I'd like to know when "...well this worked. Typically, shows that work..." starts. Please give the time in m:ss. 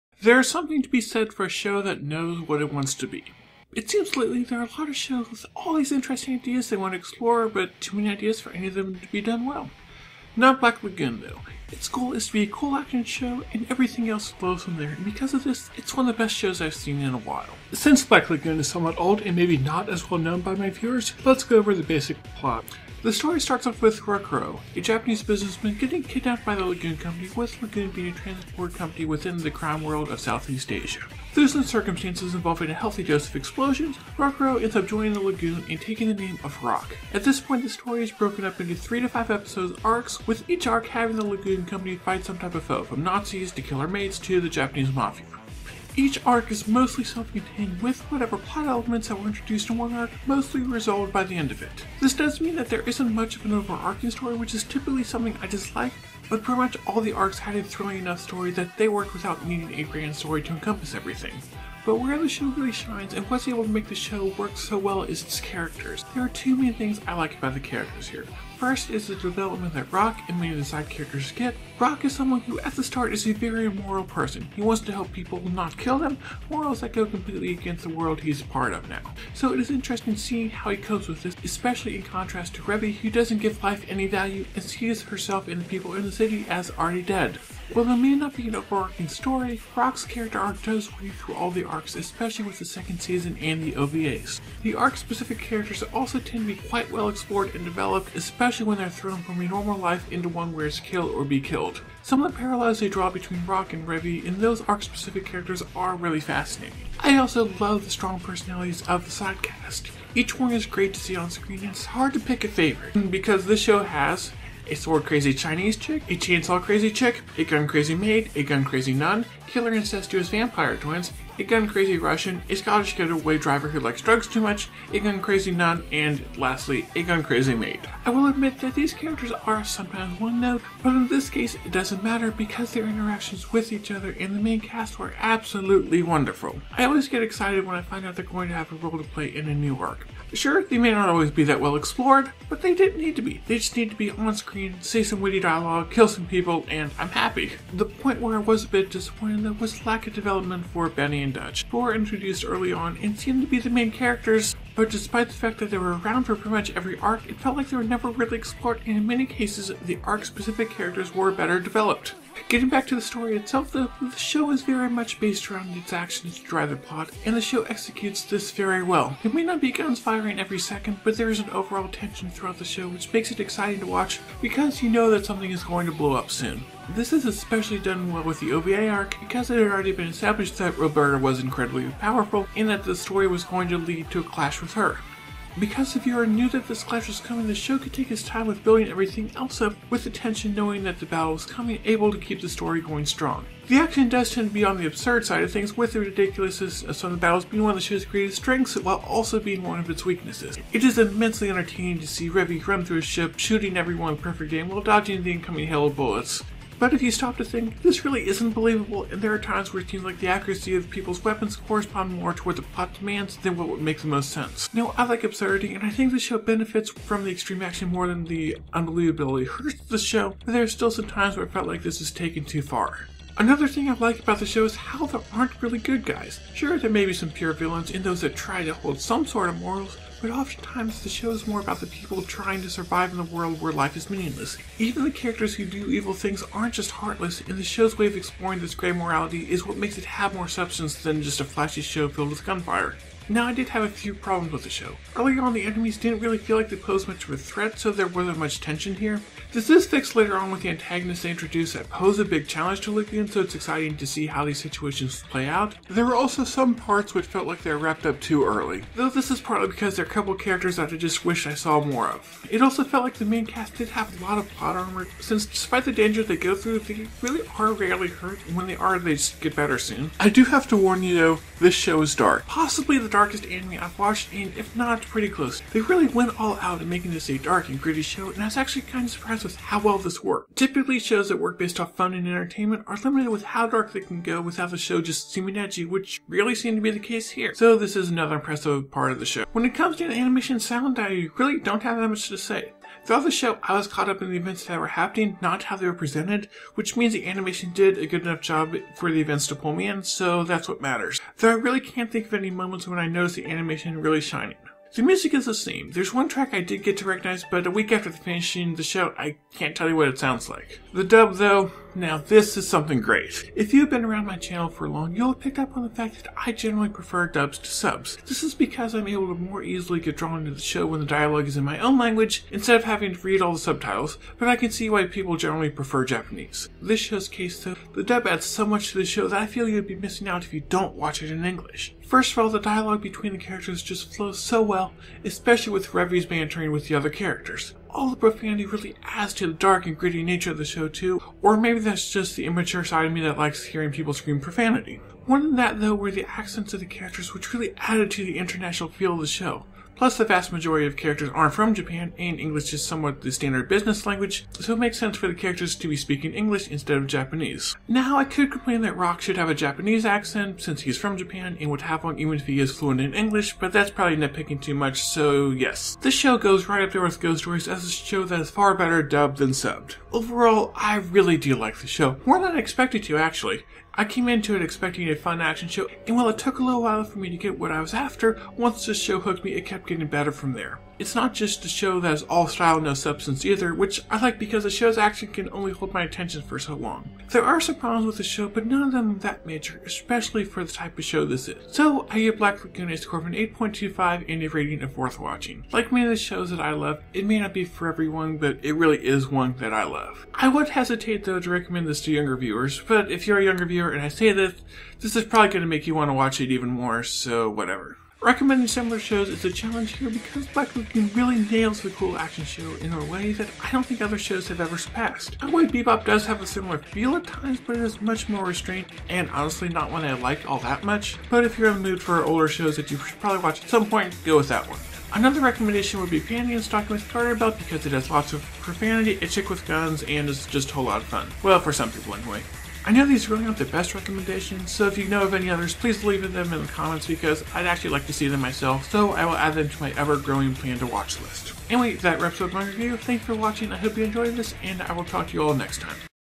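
4:39.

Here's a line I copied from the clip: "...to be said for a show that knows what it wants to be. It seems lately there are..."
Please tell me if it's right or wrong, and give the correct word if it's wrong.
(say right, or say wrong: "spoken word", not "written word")
right.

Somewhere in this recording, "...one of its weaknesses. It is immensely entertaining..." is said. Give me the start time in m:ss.
3:19.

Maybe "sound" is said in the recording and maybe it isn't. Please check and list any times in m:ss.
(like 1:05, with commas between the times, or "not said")
4:50, 5:10.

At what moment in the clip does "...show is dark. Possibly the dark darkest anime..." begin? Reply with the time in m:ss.
4:31.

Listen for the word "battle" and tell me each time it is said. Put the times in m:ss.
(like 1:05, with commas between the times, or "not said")
3:11, 3:17.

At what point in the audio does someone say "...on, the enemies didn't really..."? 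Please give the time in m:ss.
4:05.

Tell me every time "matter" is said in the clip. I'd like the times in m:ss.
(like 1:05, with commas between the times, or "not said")
2:12, 5:00.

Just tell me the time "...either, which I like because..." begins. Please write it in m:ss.
6:23.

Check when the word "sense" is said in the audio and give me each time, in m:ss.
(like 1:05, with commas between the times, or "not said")
3:34, 5:54.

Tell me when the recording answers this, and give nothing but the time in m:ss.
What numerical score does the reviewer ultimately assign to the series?
6:33.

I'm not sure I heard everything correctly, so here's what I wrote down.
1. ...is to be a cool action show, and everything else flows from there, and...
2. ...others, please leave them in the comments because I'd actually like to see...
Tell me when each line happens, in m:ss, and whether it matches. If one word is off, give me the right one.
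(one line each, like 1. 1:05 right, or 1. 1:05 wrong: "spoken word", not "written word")
1. 0:12 right
2. 7:15 right.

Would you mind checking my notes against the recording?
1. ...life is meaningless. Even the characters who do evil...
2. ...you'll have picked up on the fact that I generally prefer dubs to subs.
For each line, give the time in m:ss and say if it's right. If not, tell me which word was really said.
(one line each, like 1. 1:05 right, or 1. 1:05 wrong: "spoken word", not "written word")
1. 3:53 right
2. 5:15 right.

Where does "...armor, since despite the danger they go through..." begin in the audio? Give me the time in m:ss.
4:24.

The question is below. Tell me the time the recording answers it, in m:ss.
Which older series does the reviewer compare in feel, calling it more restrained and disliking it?
6:55.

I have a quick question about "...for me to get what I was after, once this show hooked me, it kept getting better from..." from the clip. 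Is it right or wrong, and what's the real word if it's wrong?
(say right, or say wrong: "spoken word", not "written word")
right.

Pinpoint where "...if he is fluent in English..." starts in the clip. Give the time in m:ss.
6:02.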